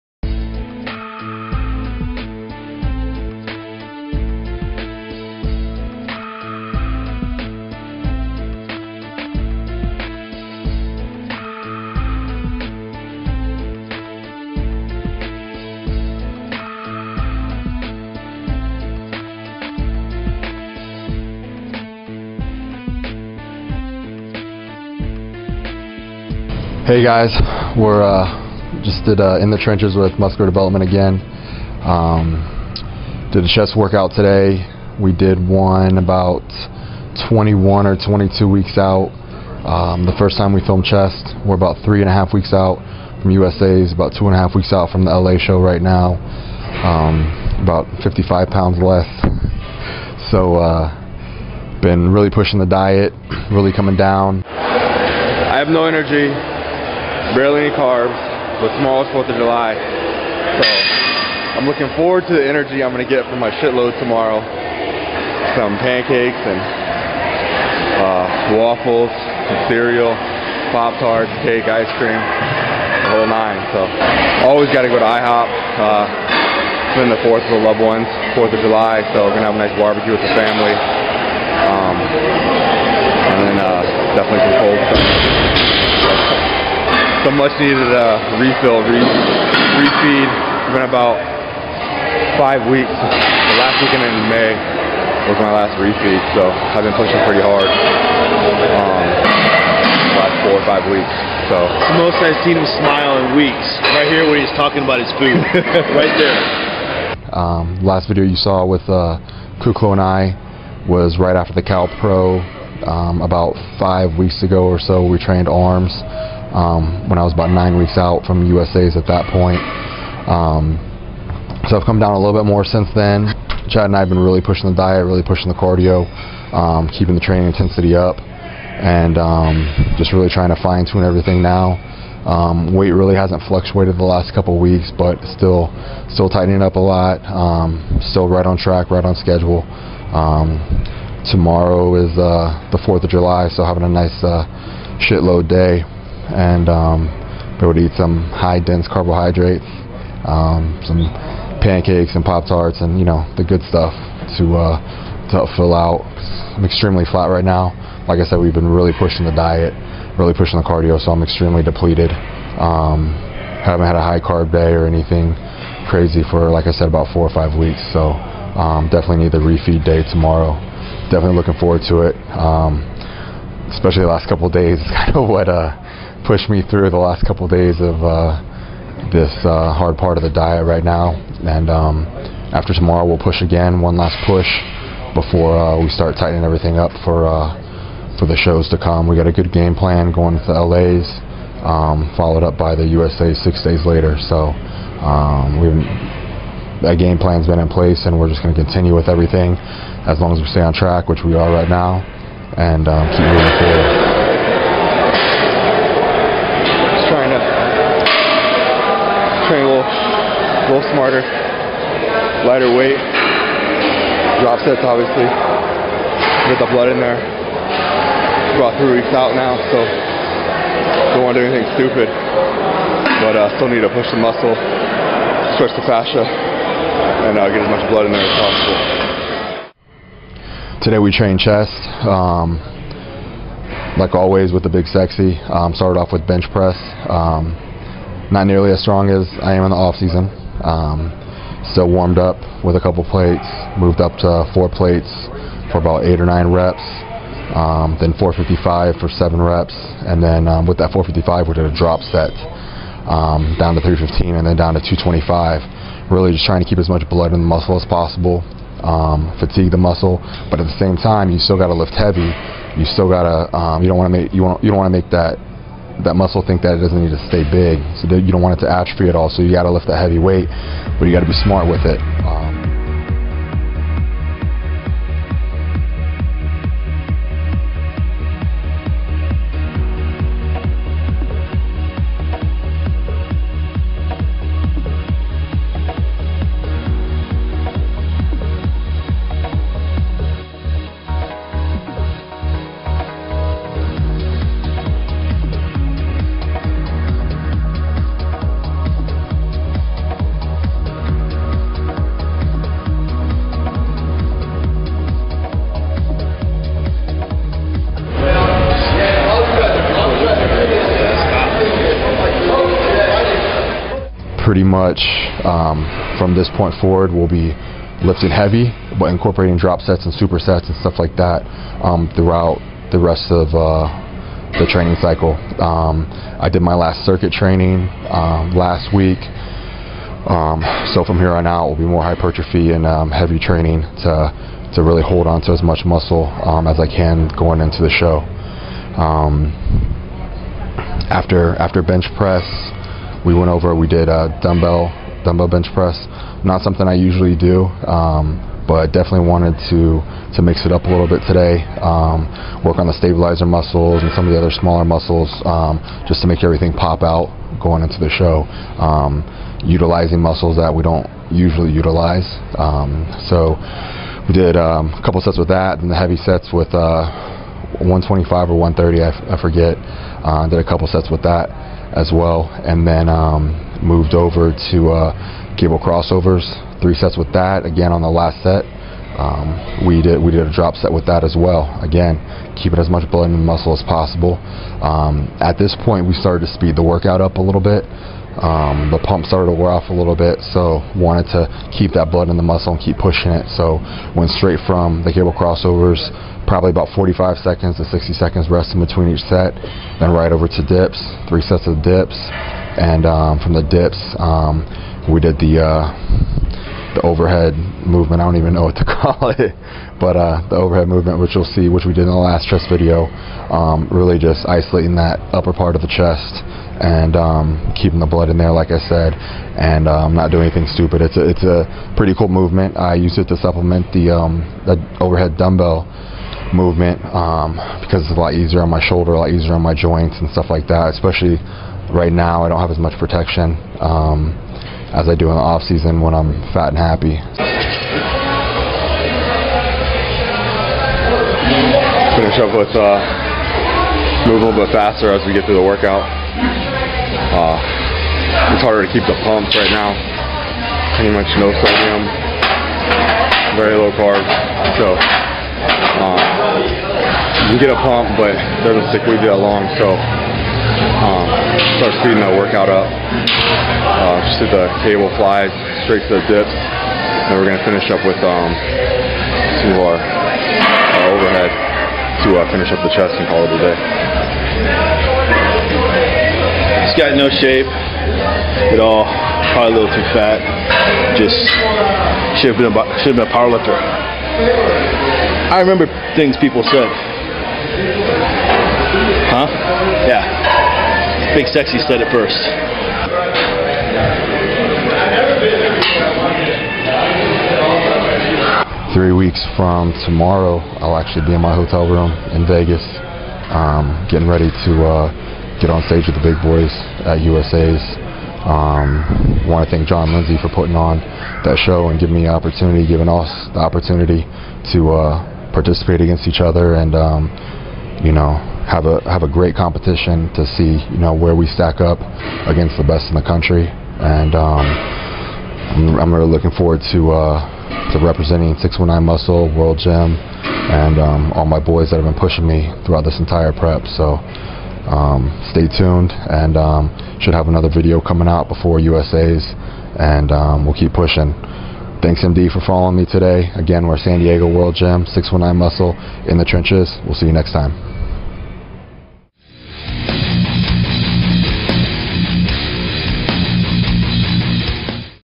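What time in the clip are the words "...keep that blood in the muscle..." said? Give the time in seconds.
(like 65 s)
391 s.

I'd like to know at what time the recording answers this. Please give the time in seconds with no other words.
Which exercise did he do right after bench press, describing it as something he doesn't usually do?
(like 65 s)
345 s.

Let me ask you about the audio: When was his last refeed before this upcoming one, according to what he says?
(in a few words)
last weekend in May.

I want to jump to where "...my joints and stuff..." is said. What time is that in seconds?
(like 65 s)
429 s.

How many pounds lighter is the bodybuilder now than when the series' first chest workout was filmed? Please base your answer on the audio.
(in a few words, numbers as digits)
55.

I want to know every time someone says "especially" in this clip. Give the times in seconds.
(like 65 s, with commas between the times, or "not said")
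173 s, 430 s.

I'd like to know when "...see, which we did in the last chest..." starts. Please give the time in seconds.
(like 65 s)
411 s.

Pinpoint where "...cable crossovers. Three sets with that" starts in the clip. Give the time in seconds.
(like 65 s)
375 s.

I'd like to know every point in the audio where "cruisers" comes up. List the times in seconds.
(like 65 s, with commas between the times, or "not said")
not said.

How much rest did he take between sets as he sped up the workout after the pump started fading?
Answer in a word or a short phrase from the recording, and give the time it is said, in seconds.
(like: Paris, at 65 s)
45 to 60 seconds, at 396 s.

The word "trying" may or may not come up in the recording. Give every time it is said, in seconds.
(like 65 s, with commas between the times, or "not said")
130 s, 256 s.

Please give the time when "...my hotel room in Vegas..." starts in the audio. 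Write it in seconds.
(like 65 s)
501 s.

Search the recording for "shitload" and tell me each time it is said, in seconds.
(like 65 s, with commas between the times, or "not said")
63 s, 145 s.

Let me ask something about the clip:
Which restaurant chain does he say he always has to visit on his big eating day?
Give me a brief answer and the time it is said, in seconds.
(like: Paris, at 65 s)
IHOP, at 75 s.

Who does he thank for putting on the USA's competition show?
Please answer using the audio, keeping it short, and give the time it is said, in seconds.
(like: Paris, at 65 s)
Jon Lindsay, at 509 s.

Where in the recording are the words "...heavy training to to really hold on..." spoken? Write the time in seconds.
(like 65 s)
333 s.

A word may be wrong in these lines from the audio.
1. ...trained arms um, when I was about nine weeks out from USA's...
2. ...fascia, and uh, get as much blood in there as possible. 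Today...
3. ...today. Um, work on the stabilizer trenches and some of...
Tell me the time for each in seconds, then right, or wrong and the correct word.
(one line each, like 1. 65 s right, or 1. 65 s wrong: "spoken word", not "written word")
1. 115 s right
2. 225 s right
3. 351 s wrong: "muscles", not "trenches".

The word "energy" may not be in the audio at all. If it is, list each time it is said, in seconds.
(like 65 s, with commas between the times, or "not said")
55 s, 62 s.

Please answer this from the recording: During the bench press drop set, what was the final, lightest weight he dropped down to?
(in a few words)
225.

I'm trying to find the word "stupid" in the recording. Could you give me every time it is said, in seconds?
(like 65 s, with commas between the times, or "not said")
221 s, 420 s.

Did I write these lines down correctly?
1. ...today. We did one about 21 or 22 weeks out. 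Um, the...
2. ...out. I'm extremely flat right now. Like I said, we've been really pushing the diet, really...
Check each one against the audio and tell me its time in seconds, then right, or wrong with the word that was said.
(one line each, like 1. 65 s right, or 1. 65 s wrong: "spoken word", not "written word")
1. 34 s right
2. 155 s right.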